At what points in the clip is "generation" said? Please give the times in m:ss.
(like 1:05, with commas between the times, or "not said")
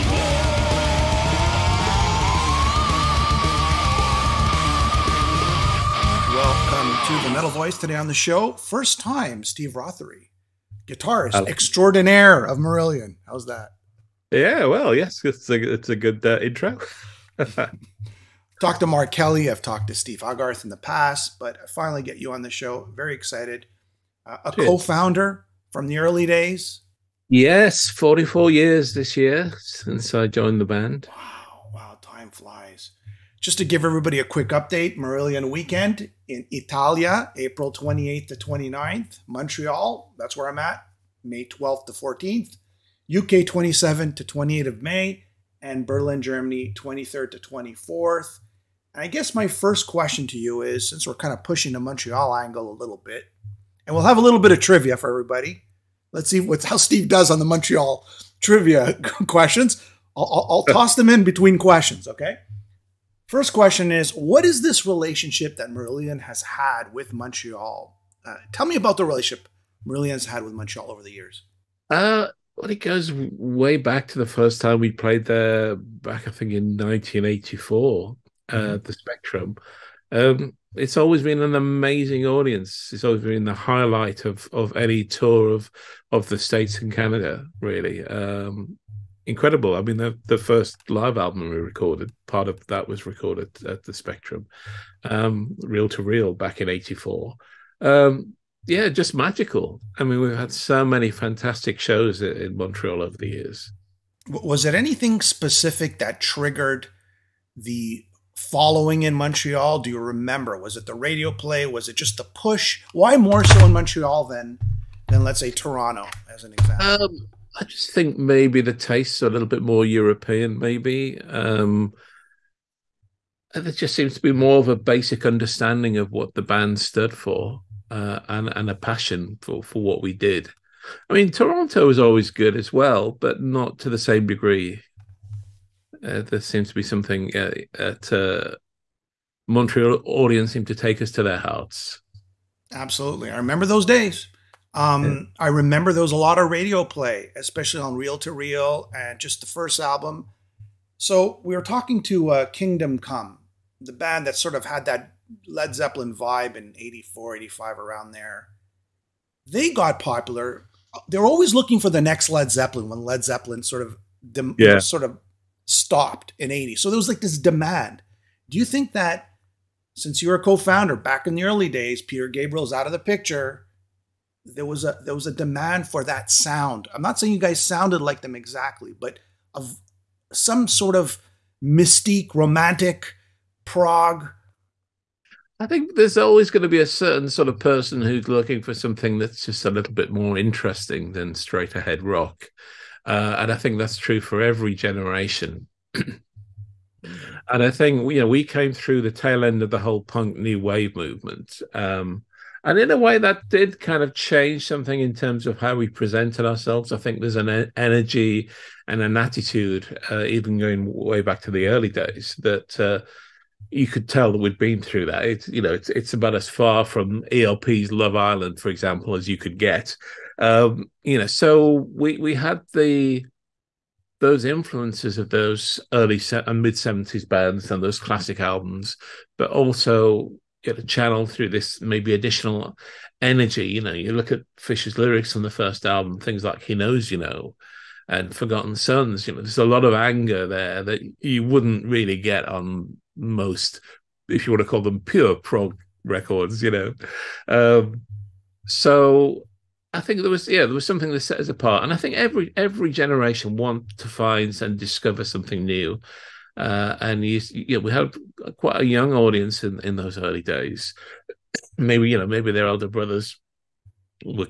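3:14, 4:12.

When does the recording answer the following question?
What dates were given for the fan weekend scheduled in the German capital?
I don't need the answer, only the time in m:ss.
0:46.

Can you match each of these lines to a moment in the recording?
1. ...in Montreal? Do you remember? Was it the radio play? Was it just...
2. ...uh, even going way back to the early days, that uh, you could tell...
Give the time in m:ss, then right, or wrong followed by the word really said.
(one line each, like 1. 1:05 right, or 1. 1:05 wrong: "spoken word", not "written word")
1. 1:49 right
2. 3:30 right.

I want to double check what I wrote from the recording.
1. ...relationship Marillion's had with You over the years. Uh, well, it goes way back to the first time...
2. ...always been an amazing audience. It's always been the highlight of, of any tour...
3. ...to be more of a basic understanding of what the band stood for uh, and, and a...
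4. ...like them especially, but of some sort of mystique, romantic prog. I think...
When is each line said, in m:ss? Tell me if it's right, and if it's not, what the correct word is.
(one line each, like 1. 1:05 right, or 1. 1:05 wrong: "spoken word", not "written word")
1. 1:09 wrong: "Montreal", not "You"
2. 1:20 right
3. 2:04 right
4. 2:57 wrong: "exactly", not "especially".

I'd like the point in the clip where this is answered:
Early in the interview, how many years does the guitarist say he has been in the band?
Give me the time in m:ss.
0:27.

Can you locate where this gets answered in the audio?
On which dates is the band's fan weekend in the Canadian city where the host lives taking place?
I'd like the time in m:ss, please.
0:41.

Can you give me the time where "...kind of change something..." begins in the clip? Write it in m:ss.
3:23.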